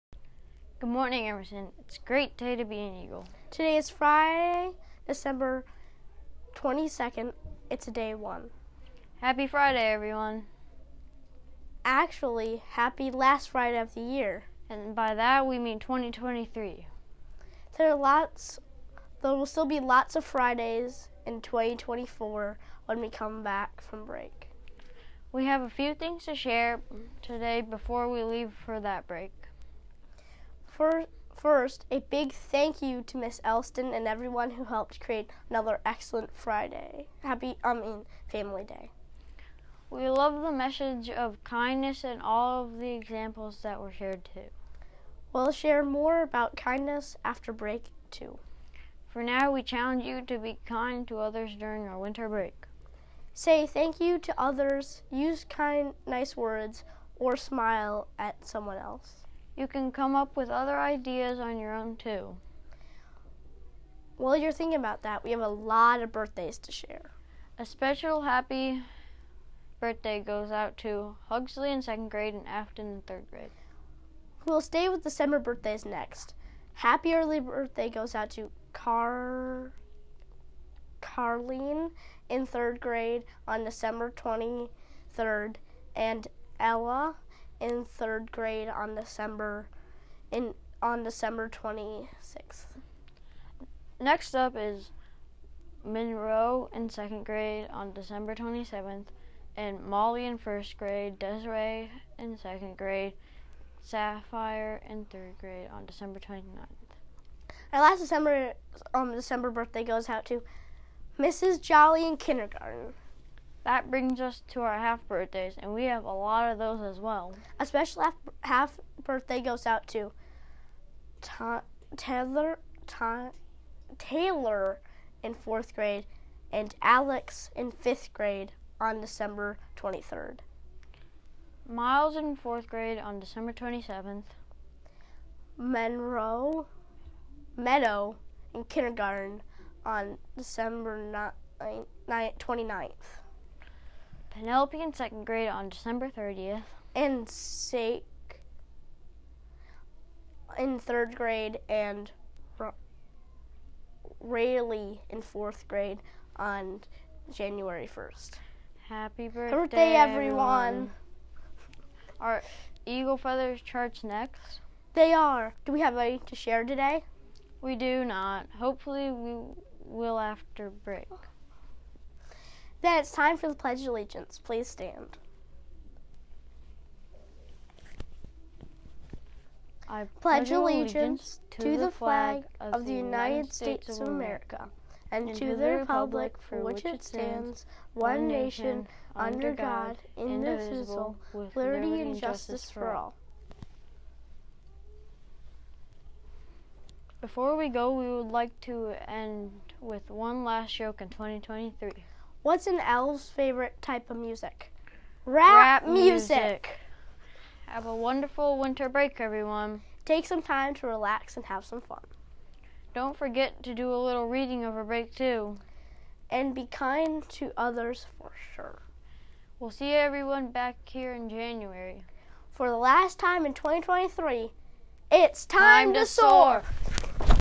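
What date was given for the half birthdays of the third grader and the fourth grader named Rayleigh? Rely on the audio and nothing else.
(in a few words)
January 1st.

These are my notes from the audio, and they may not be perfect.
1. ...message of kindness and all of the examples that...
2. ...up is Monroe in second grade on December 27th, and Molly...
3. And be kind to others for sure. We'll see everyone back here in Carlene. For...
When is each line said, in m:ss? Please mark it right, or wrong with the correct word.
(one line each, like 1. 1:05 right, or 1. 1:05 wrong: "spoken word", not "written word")
1. 0:40 right
2. 1:34 right
3. 3:36 wrong: "January", not "Carlene".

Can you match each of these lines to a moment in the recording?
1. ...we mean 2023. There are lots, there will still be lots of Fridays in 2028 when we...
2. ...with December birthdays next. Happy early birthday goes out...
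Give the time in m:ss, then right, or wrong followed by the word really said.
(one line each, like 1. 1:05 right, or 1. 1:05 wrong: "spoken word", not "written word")
1. 0:15 wrong: "2024", not "2028"
2. 1:14 right.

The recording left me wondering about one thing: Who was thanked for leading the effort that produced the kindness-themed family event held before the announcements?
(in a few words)
Miss Elston.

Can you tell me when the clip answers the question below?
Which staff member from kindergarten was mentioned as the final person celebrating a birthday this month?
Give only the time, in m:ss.
1:51.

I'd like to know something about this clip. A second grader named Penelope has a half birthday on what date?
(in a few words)
December 30th.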